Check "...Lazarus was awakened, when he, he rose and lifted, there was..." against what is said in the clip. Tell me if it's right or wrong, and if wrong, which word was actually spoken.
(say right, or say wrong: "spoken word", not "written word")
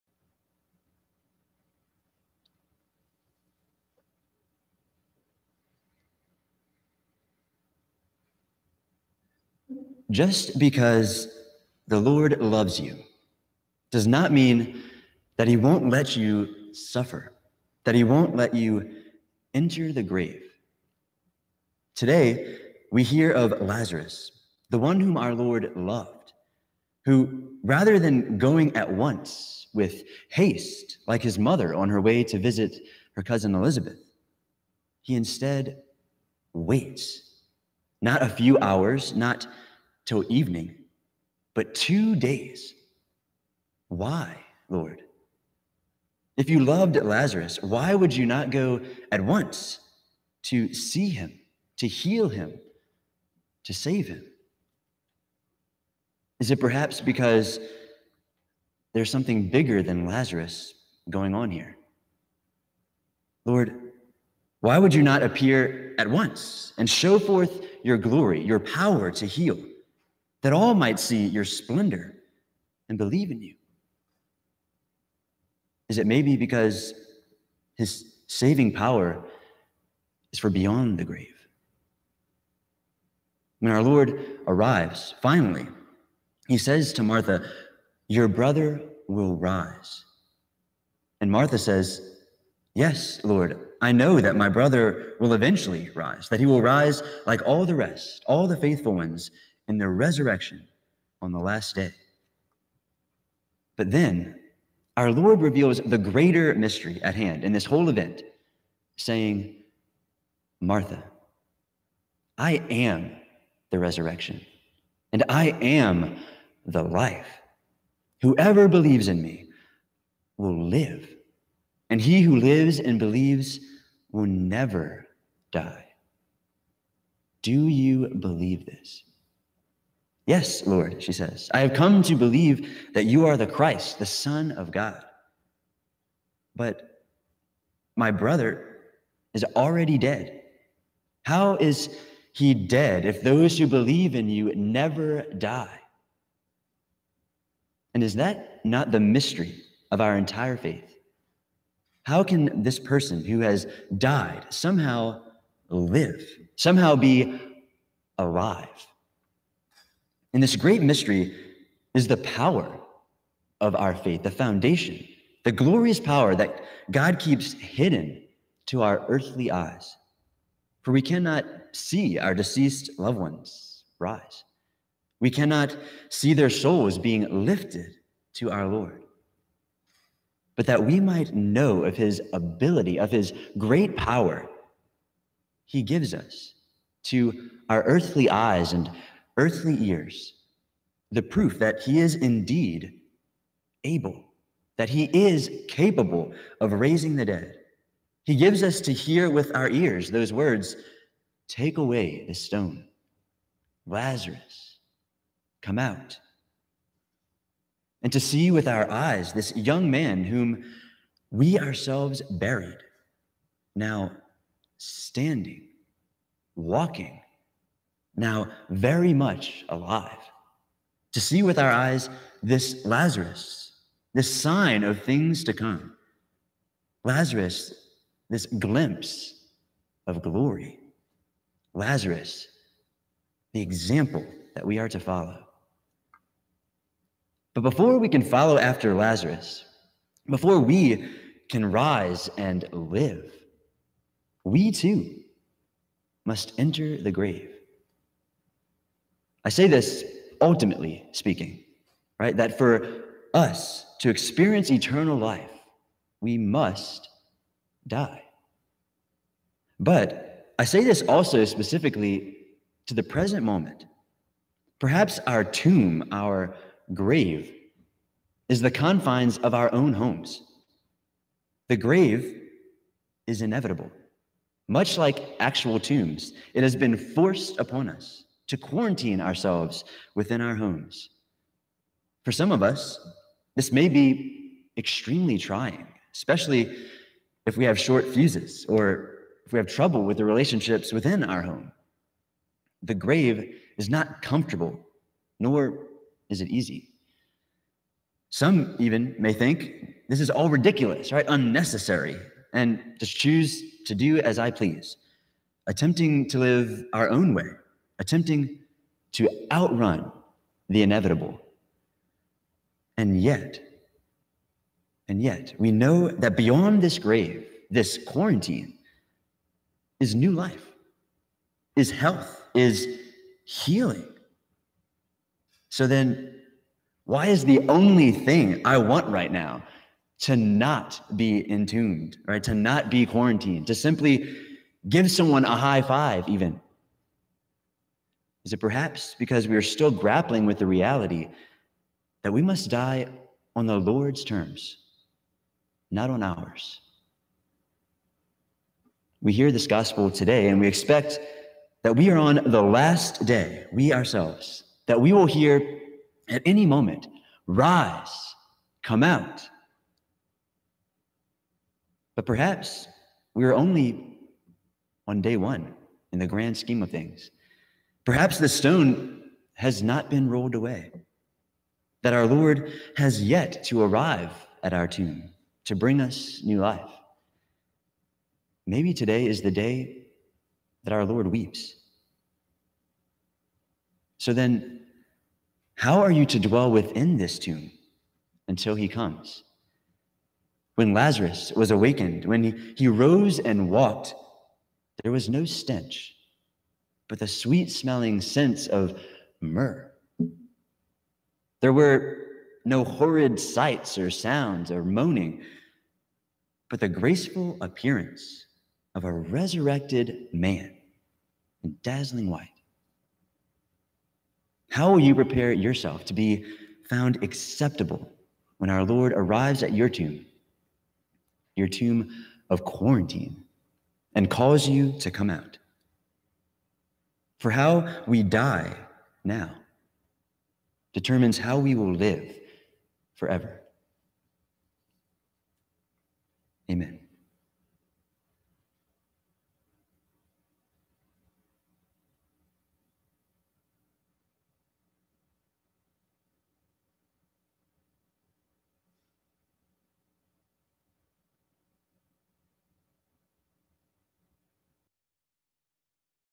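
wrong: "walked", not "lifted".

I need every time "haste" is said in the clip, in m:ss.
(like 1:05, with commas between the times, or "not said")
0:30.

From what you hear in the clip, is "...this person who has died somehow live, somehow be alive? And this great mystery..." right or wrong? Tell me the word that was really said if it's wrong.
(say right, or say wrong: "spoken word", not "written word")
right.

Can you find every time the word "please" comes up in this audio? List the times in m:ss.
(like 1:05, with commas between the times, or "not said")
5:04.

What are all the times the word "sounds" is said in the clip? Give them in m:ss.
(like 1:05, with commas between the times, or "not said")
6:44.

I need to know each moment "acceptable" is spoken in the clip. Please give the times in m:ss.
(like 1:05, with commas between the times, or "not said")
6:57.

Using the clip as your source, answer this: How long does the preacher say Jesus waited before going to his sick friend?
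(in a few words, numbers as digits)
2 days.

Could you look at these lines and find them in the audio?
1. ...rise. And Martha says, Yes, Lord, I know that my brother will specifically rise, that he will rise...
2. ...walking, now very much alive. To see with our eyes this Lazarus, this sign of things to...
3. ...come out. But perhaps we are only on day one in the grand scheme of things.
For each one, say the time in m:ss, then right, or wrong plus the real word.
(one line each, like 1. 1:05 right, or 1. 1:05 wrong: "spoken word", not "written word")
1. 1:29 wrong: "eventually", not "specifically"
2. 3:36 right
3. 5:58 right.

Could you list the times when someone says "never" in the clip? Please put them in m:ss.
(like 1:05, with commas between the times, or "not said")
2:04, 2:24.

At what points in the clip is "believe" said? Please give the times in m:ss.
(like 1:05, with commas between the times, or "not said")
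1:12, 1:58, 2:02, 2:08, 2:12, 2:23.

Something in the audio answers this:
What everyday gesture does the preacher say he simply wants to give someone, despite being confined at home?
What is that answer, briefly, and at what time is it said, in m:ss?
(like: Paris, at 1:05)
A high five, at 5:35.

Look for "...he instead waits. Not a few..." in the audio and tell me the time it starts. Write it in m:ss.
0:35.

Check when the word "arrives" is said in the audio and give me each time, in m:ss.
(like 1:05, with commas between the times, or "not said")
1:24, 6:13, 6:59.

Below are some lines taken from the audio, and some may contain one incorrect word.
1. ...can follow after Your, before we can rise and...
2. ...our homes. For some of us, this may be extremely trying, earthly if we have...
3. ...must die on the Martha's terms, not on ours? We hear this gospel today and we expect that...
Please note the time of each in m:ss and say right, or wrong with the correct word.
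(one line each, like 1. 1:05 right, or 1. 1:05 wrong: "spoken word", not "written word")
1. 3:58 wrong: "Lazarus", not "Your"
2. 4:40 wrong: "especially", not "earthly"
3. 5:42 wrong: "Lord", not "Martha".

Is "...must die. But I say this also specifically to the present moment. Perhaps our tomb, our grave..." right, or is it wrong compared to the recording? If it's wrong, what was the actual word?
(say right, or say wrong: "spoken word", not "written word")
right.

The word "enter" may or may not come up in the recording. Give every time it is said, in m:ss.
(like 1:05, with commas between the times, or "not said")
0:19, 4:06.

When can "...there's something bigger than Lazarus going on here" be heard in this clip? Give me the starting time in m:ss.
0:58.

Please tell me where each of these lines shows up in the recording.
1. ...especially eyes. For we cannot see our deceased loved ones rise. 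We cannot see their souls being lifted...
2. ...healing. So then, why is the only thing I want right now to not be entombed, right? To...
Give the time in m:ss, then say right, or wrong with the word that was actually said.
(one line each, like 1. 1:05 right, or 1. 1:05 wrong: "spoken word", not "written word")
1. 2:49 wrong: "earthly", not "especially"
2. 5:23 right.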